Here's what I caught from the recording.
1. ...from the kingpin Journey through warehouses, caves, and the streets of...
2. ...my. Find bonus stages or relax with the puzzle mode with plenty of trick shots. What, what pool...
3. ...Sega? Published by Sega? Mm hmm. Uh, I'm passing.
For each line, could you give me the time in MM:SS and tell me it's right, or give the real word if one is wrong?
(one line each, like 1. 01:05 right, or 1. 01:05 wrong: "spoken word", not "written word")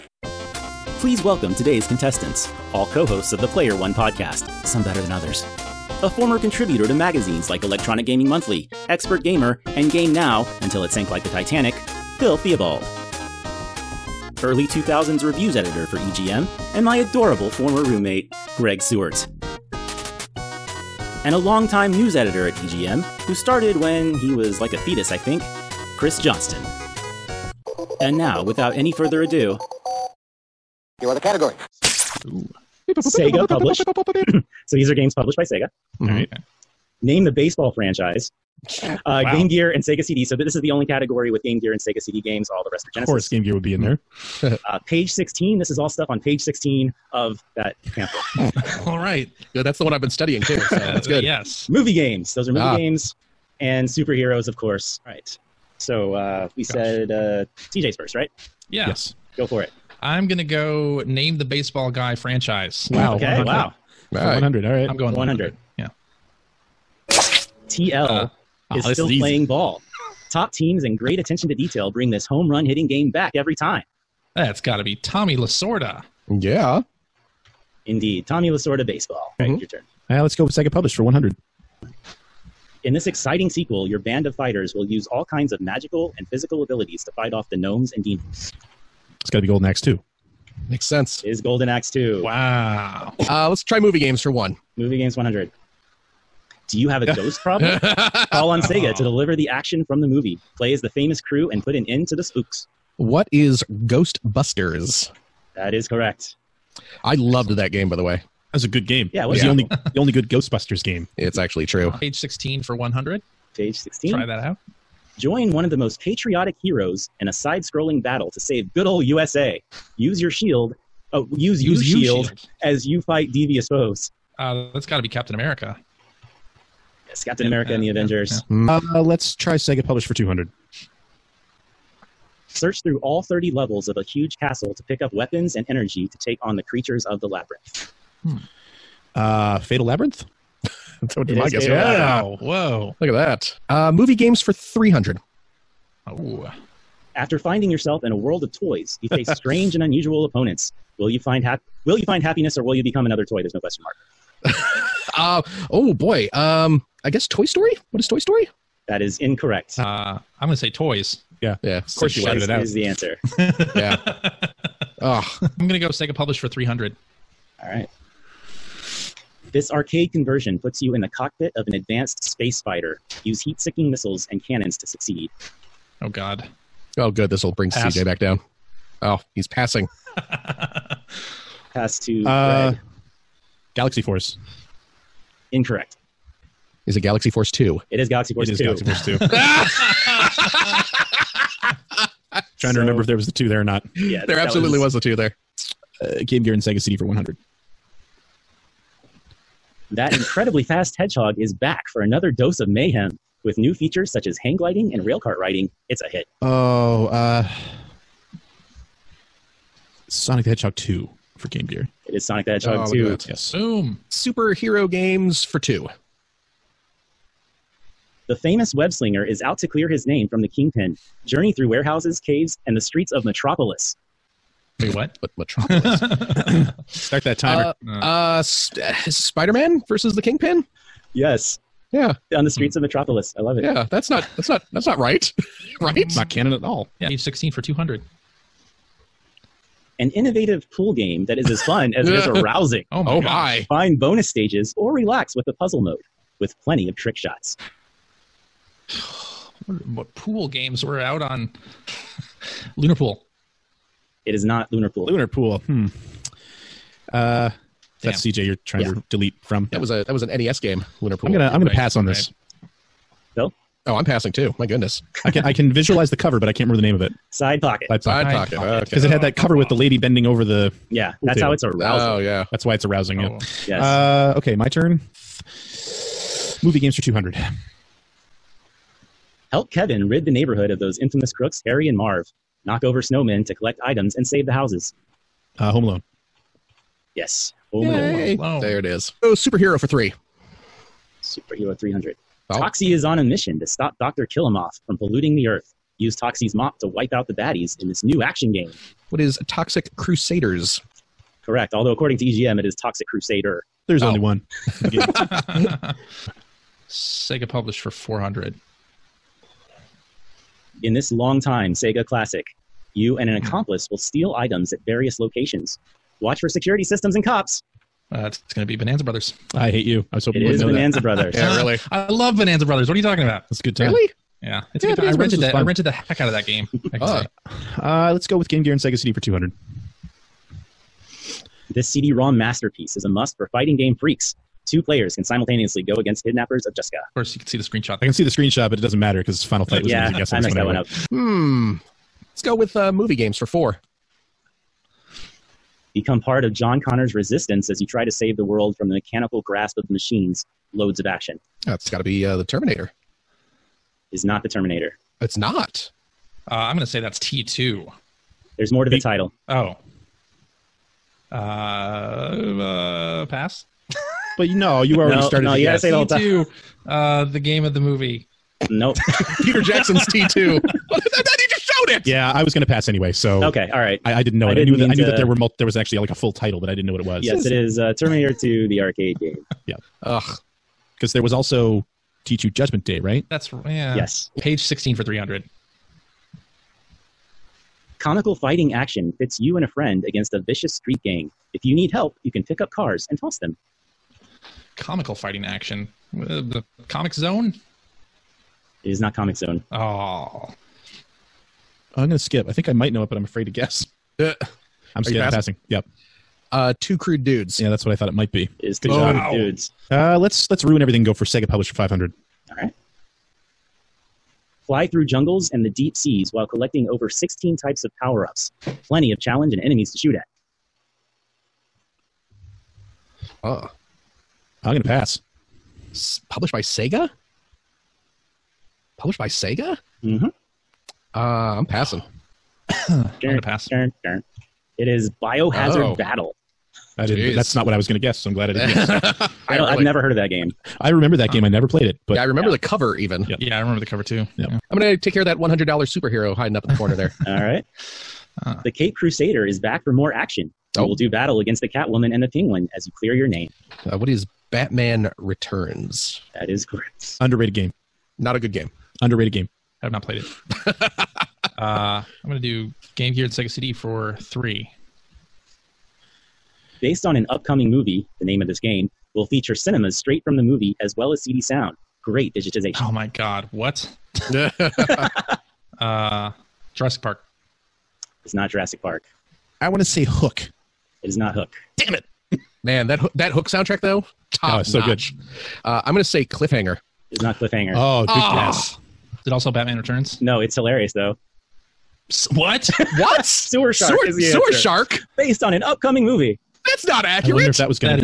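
1. 03:40 right
2. 04:03 right
3. 07:06 right.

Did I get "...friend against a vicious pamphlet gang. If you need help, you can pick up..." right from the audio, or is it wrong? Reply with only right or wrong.
wrong.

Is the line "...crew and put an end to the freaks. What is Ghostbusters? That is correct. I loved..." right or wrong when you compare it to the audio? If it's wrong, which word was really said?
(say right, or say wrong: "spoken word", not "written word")
wrong: "spooks", not "freaks".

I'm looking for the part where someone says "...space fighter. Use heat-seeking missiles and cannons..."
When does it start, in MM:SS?
02:52.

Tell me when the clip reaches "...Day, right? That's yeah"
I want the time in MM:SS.
06:22.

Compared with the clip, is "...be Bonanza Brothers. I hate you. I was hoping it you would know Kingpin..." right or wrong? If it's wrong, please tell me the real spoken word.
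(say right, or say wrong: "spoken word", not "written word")
wrong: "Bonanza", not "Kingpin".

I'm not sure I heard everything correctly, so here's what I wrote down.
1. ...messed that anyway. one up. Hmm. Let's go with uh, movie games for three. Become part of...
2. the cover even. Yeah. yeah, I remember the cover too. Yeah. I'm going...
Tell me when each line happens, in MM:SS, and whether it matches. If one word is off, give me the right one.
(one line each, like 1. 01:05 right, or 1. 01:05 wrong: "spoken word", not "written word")
1. 05:40 wrong: "four", not "three"
2. 07:22 right.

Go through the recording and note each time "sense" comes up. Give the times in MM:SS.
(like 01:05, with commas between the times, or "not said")
01:30.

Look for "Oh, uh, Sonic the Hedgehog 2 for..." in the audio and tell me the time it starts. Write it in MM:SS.
03:26.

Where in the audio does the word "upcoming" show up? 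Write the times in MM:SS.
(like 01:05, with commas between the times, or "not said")
07:47, 08:15.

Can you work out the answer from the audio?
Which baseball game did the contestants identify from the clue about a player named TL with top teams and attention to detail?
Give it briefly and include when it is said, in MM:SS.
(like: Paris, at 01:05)
Tommy Lasorda baseball, at 01:18.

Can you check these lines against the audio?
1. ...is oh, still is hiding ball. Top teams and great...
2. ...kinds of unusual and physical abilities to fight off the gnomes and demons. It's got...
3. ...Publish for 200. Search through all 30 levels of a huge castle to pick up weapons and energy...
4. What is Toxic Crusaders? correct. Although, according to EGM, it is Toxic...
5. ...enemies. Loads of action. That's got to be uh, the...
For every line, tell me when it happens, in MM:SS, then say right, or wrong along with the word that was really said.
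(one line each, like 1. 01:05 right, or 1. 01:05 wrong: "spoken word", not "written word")
1. 01:08 wrong: "playing", not "hiding"
2. 01:25 wrong: "magical", not "unusual"
3. 02:09 right
4. 04:59 right
5. 05:49 wrong: "machines", not "enemies".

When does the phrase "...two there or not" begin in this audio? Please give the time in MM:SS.
03:13.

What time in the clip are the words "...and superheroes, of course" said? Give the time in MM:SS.
00:53.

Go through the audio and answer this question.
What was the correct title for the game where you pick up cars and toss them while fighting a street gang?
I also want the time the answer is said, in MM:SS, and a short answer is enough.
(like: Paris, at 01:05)
Two Crude Dudes, at 06:46.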